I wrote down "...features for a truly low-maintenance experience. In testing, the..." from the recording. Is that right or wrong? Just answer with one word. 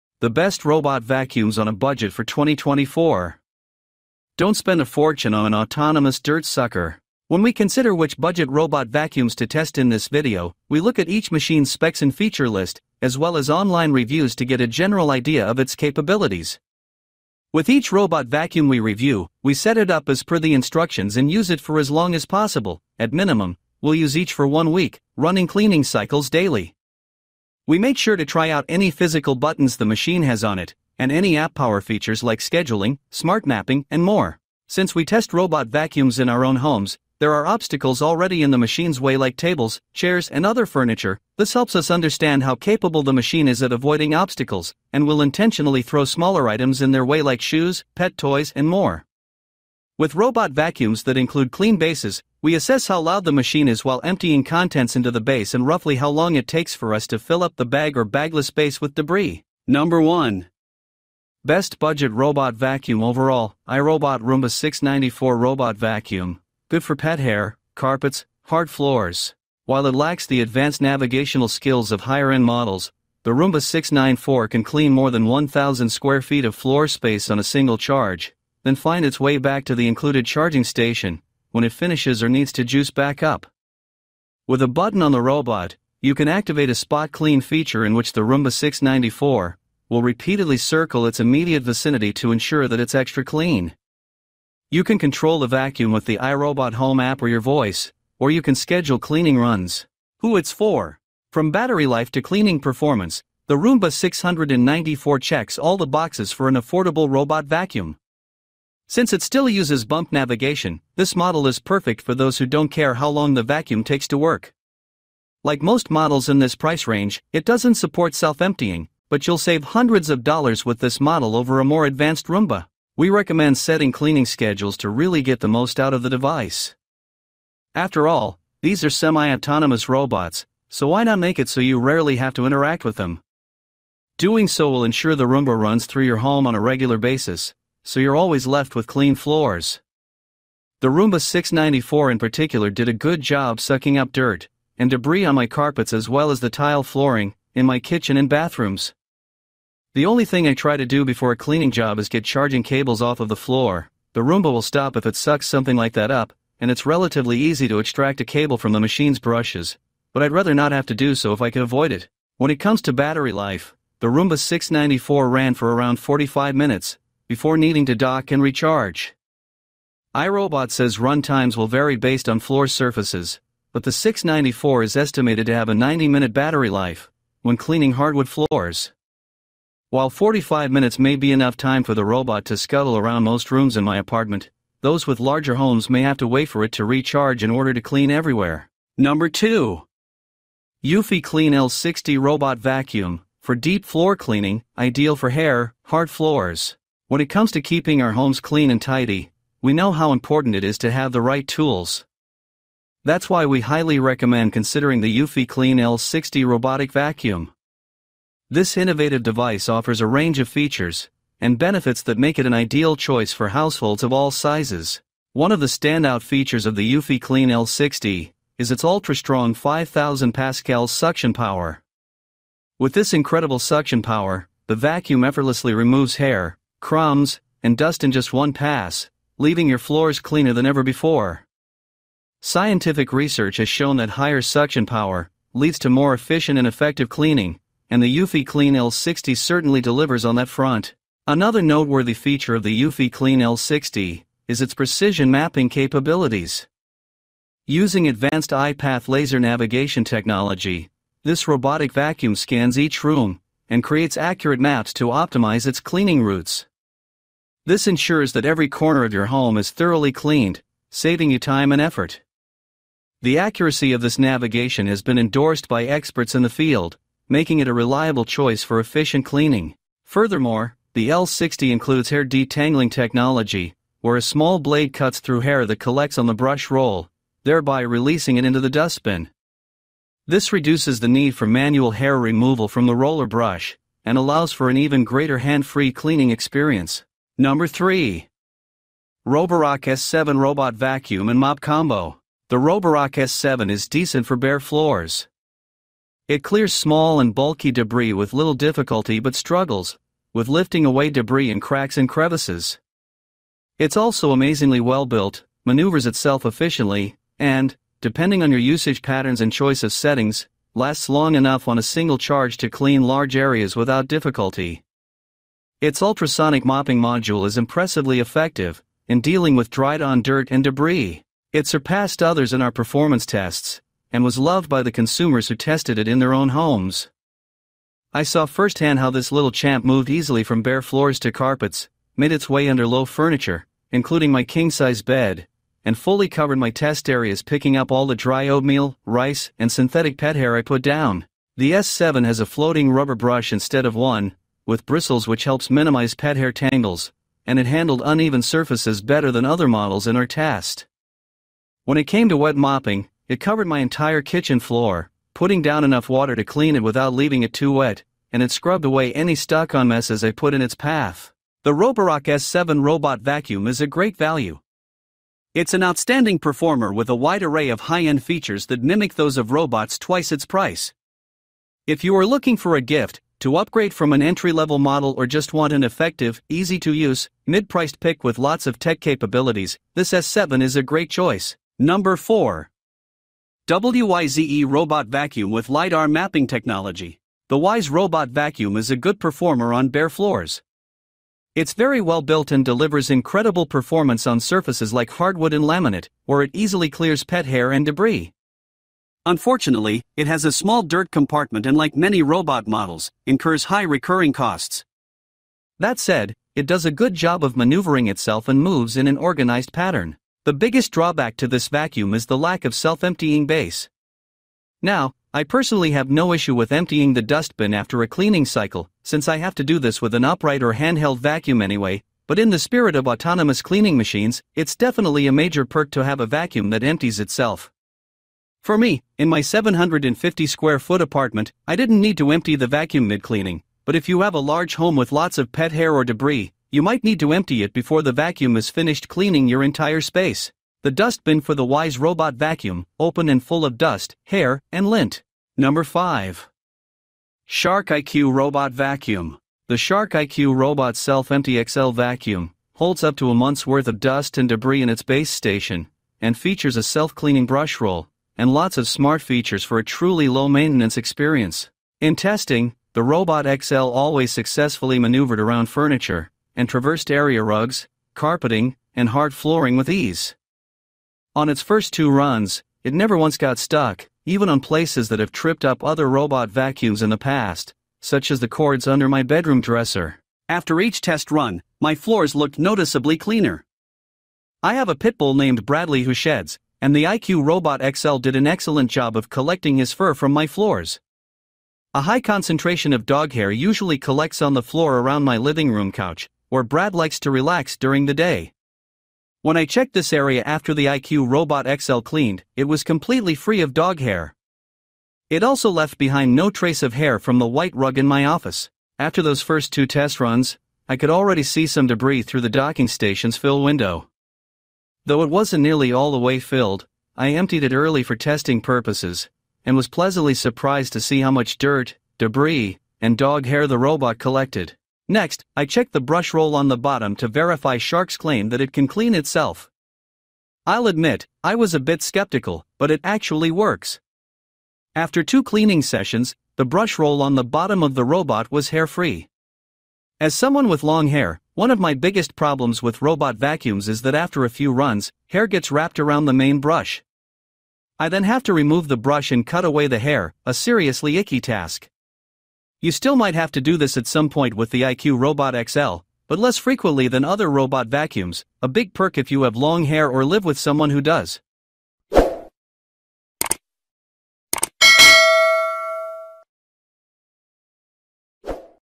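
right.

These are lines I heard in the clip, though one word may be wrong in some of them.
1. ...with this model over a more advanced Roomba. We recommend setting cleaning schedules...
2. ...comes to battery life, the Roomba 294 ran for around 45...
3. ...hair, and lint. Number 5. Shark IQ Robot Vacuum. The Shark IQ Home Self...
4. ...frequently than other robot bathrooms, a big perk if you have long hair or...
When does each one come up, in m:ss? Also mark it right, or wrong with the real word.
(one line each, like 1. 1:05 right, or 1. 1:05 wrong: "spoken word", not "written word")
1. 2:00 right
2. 2:42 wrong: "694", not "294"
3. 7:24 wrong: "Robot", not "Home"
4. 9:16 wrong: "vacuums", not "bathrooms".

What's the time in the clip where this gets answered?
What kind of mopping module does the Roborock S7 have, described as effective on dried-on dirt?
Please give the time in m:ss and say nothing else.
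5:15.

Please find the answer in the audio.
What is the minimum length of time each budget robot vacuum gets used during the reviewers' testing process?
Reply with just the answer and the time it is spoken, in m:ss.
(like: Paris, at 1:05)
one week, at 0:24.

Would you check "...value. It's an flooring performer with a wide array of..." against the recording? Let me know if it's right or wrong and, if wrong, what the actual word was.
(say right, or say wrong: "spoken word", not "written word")
wrong: "outstanding", not "flooring".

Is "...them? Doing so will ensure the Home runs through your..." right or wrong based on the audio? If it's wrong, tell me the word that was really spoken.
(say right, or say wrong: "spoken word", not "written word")
wrong: "Roomba", not "Home".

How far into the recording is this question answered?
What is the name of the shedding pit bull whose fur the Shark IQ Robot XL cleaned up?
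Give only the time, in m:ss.
8:05.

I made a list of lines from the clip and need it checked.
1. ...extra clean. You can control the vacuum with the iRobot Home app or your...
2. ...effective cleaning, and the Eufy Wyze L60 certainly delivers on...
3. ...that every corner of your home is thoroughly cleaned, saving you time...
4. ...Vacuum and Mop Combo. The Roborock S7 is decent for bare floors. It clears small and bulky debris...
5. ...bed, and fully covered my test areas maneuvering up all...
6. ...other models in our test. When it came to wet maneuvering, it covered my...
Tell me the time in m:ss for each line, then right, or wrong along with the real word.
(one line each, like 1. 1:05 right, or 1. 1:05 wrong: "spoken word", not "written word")
1. 1:32 right
2. 3:56 wrong: "Clean", not "Wyze"
3. 4:18 right
4. 4:50 right
5. 5:35 wrong: "picking", not "maneuvering"
6. 5:49 wrong: "mopping", not "maneuvering".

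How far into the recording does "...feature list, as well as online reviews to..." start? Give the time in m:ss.
0:12.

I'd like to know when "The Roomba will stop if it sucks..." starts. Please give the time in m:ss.
2:34.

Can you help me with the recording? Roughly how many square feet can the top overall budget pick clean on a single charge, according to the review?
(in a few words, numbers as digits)
1,000.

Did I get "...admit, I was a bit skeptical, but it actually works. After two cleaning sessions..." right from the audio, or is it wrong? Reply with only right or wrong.
right.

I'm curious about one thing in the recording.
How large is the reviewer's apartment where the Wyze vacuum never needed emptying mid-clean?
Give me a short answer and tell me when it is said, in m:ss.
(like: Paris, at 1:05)
750 square feet, at 7:09.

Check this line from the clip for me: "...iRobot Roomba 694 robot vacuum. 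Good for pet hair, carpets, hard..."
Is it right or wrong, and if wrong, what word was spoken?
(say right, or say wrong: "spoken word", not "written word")
right.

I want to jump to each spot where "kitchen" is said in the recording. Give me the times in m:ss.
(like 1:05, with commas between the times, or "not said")
2:27, 5:54.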